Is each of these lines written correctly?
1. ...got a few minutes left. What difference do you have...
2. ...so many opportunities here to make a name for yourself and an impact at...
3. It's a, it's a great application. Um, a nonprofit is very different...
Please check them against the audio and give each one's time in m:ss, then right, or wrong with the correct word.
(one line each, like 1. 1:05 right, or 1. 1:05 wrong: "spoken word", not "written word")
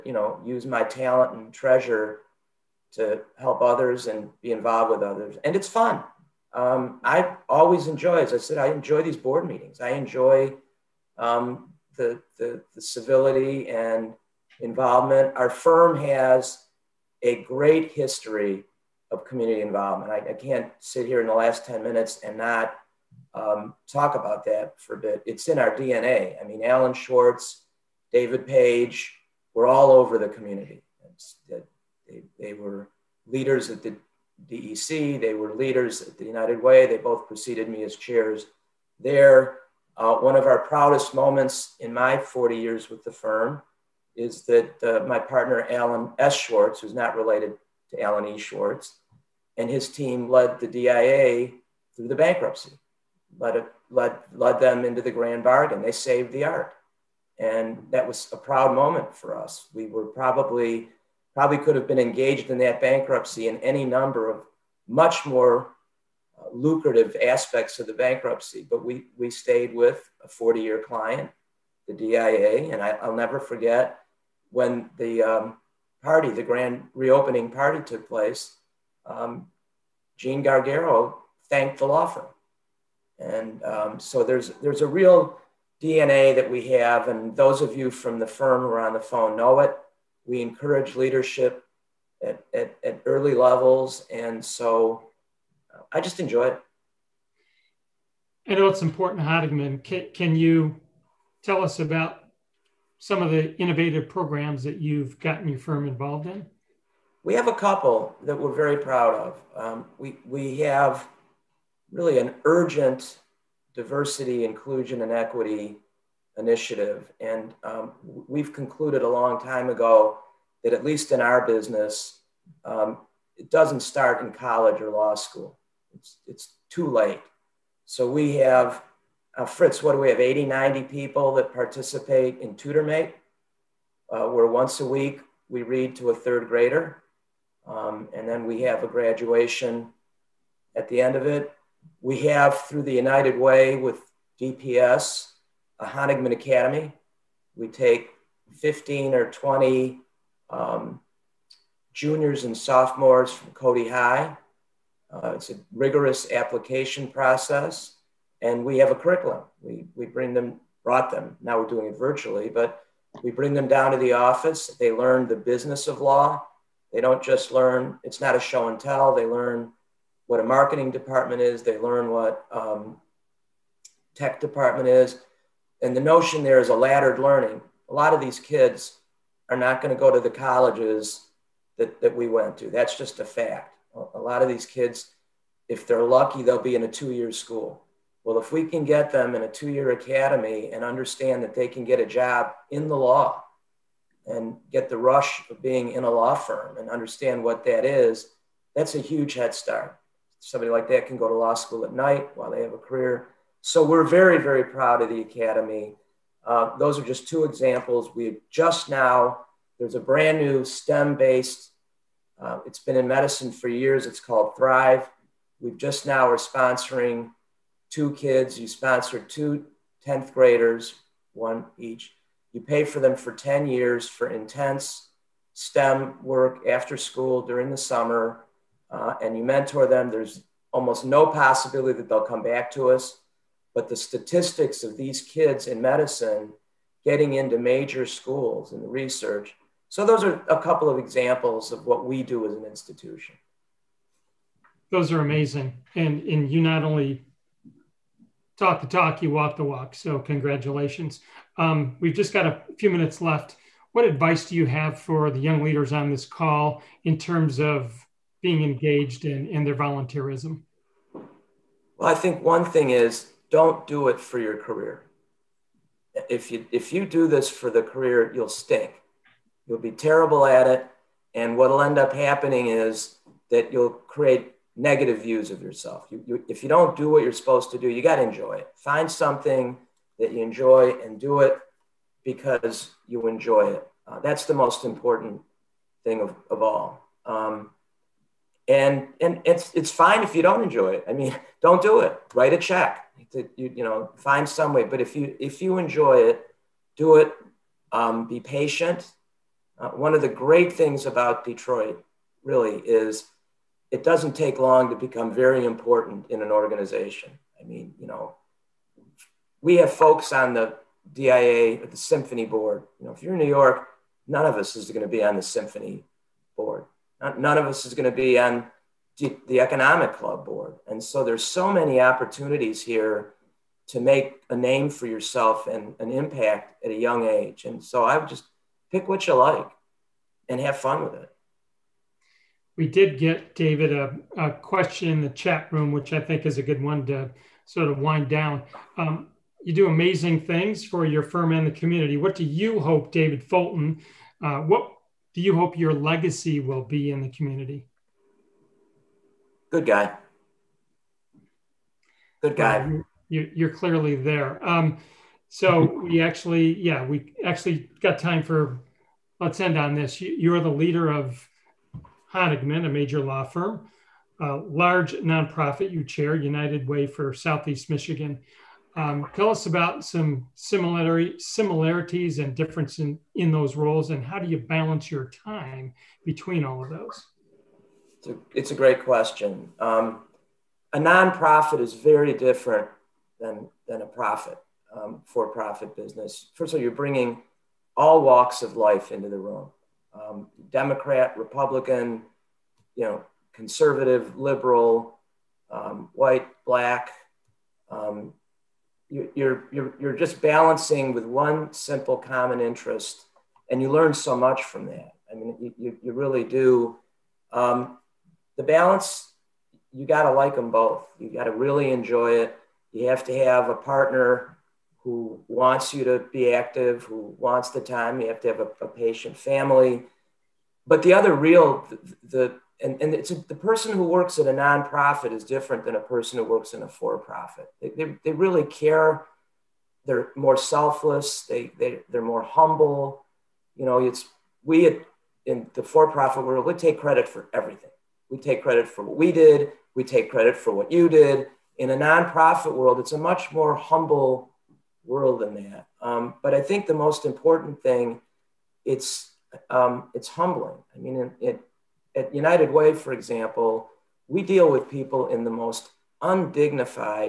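1. 4:12 wrong: "advice", not "difference"
2. 5:21 right
3. 6:18 wrong: "question", not "application".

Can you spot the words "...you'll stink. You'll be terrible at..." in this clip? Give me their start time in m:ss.
4:28.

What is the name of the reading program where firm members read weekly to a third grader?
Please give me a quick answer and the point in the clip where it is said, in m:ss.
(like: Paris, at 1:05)
TutorMate, at 2:12.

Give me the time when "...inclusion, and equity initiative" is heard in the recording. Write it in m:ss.
1:54.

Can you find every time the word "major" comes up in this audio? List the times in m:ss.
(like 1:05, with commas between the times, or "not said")
3:57, 6:02.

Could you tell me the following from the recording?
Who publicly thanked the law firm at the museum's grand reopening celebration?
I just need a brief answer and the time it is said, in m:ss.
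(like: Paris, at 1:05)
Gene Gargaro, at 1:20.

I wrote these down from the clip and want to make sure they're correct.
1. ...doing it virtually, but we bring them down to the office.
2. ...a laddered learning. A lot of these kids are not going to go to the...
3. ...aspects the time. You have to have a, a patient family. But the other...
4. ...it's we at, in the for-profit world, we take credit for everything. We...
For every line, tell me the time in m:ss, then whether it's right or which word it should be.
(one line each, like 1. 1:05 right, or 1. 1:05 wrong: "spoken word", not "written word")
1. 2:41 right
2. 2:56 right
3. 6:57 wrong: "wants", not "aspects"
4. 7:14 right.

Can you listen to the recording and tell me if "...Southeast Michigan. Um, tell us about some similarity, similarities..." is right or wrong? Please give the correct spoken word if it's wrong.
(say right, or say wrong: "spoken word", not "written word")
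right.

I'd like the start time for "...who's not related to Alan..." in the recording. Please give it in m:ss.
0:46.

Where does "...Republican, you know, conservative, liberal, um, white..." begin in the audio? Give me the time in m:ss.
6:31.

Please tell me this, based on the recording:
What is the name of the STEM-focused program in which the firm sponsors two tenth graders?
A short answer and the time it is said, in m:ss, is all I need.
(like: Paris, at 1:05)
Thrive, at 3:34.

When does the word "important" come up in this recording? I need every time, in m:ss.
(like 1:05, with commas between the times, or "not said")
1:38, 4:44, 5:05, 7:27.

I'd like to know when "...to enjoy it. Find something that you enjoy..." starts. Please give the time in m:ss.
4:38.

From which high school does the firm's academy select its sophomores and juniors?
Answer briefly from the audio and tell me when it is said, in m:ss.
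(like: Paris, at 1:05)
Cody High, at 2:33.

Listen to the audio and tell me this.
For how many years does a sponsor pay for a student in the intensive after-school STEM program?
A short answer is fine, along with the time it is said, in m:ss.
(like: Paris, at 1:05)
10, at 3:43.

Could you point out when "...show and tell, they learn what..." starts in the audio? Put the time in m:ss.
2:48.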